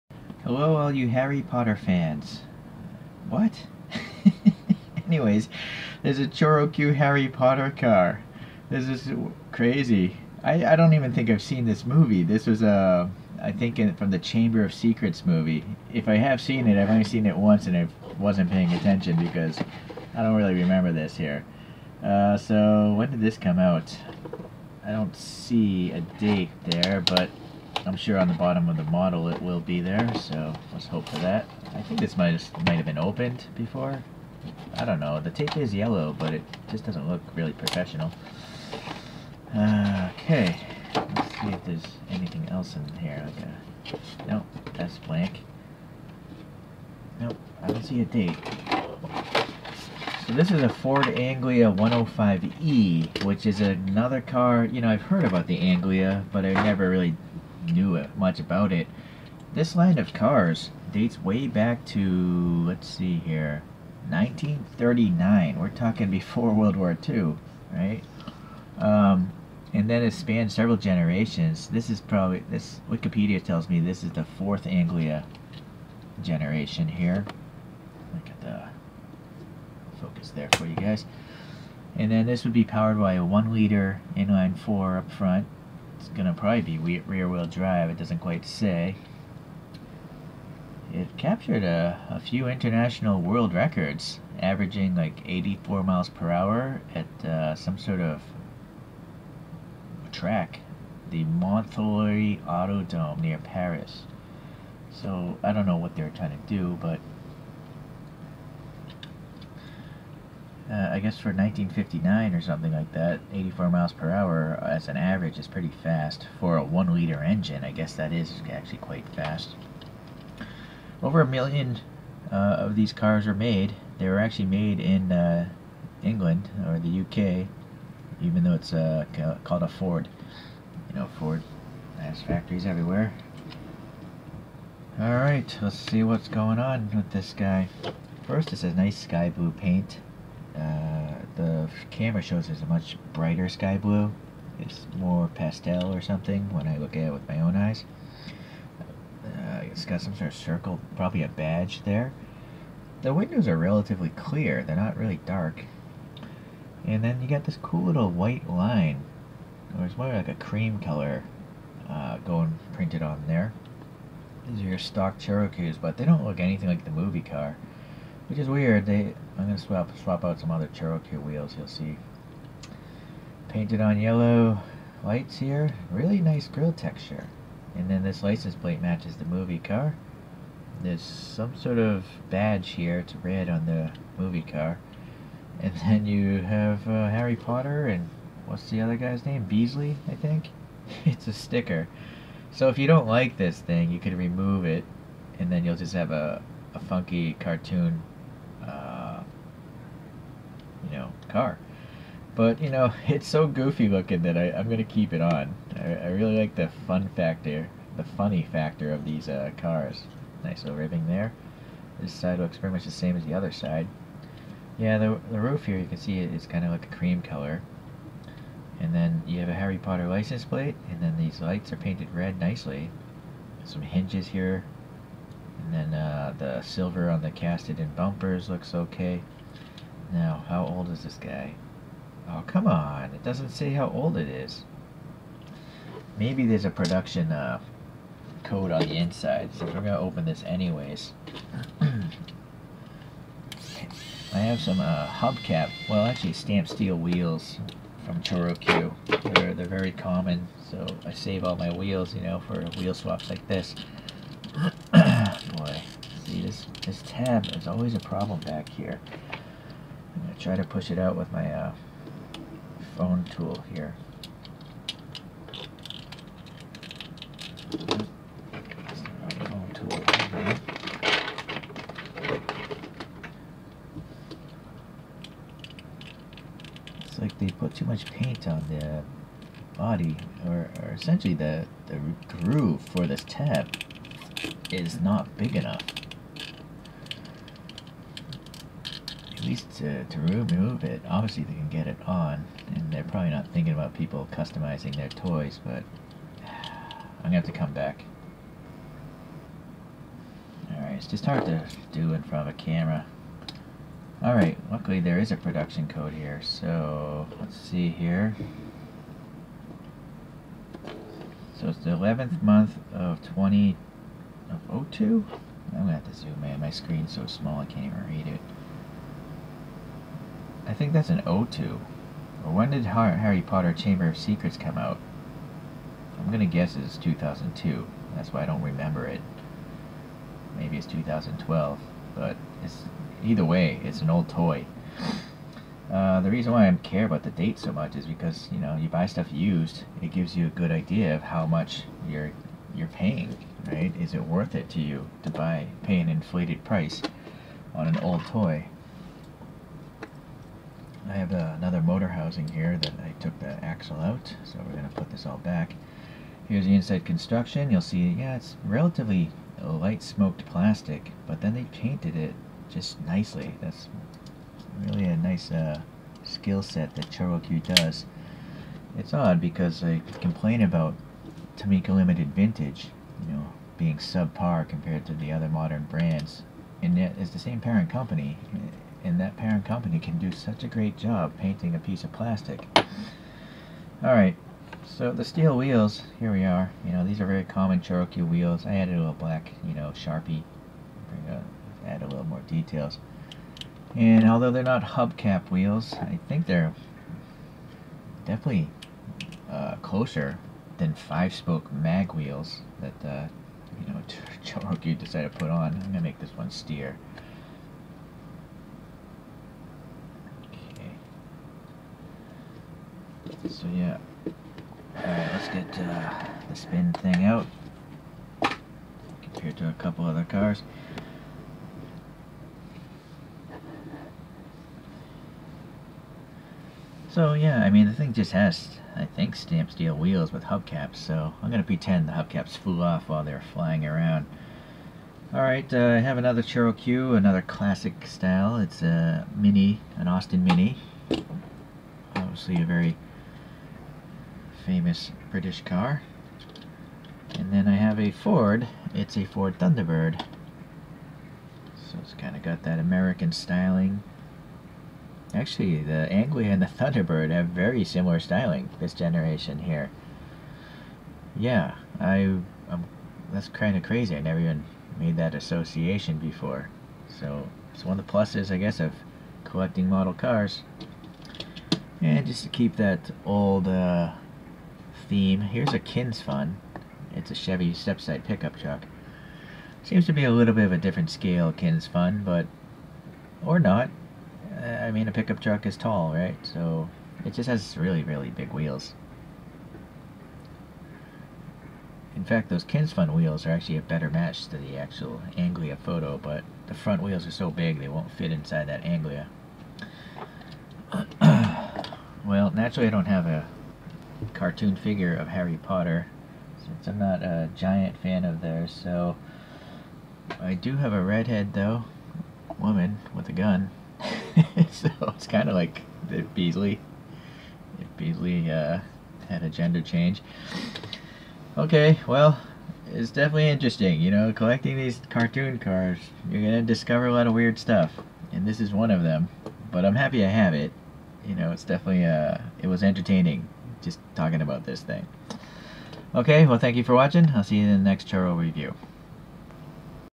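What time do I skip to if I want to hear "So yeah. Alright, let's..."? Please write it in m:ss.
6:53.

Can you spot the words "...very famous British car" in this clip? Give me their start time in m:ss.
7:22.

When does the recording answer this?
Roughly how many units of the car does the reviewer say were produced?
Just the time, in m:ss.
2:01.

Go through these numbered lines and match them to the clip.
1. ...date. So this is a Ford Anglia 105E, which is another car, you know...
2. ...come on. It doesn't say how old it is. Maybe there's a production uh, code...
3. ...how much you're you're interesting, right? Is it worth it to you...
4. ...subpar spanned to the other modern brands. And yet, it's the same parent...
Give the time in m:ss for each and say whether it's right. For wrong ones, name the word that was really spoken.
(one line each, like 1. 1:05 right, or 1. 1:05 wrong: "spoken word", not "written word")
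1. 0:48 right
2. 3:52 right
3. 5:41 wrong: "paying", not "interesting"
4. 6:13 wrong: "compared", not "spanned".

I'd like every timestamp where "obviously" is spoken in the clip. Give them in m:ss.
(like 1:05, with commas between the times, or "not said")
4:51, 7:22.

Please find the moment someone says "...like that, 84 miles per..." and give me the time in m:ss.
1:52.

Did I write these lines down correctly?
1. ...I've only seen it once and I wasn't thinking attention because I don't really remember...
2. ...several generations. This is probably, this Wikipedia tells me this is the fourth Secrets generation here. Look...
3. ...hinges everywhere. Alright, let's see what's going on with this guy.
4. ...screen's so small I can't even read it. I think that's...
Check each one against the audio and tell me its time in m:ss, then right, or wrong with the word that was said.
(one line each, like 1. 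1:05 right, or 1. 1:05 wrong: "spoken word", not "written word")
1. 0:16 wrong: "paying", not "thinking"
2. 1:10 wrong: "Anglia", not "Secrets"
3. 2:12 wrong: "factories", not "hinges"
4. 5:16 right.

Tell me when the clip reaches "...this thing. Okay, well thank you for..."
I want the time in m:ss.
8:54.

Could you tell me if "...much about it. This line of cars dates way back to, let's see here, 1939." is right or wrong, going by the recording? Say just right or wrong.
right.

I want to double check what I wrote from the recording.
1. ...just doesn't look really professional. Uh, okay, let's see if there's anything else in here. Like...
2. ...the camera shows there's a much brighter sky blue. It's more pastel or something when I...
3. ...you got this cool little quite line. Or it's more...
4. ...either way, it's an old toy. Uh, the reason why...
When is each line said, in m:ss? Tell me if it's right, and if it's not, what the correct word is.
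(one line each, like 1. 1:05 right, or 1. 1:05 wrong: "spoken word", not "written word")
1. 0:36 right
2. 2:21 right
3. 2:37 wrong: "white", not "quite"
4. 5:33 right.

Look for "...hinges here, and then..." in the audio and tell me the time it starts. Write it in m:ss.
3:43.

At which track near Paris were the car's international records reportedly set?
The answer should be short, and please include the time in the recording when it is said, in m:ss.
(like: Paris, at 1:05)
Montreuil Autodome, at 1:41.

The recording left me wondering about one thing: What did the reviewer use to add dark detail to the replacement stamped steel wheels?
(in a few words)
Sharpie.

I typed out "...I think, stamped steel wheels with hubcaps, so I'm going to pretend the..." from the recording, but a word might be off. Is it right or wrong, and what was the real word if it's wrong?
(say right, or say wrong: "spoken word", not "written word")
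right.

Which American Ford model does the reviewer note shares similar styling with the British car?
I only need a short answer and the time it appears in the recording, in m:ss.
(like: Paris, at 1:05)
Ford Thunderbird, at 7:29.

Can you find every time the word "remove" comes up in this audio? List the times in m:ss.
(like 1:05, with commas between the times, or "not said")
3:14, 4:50.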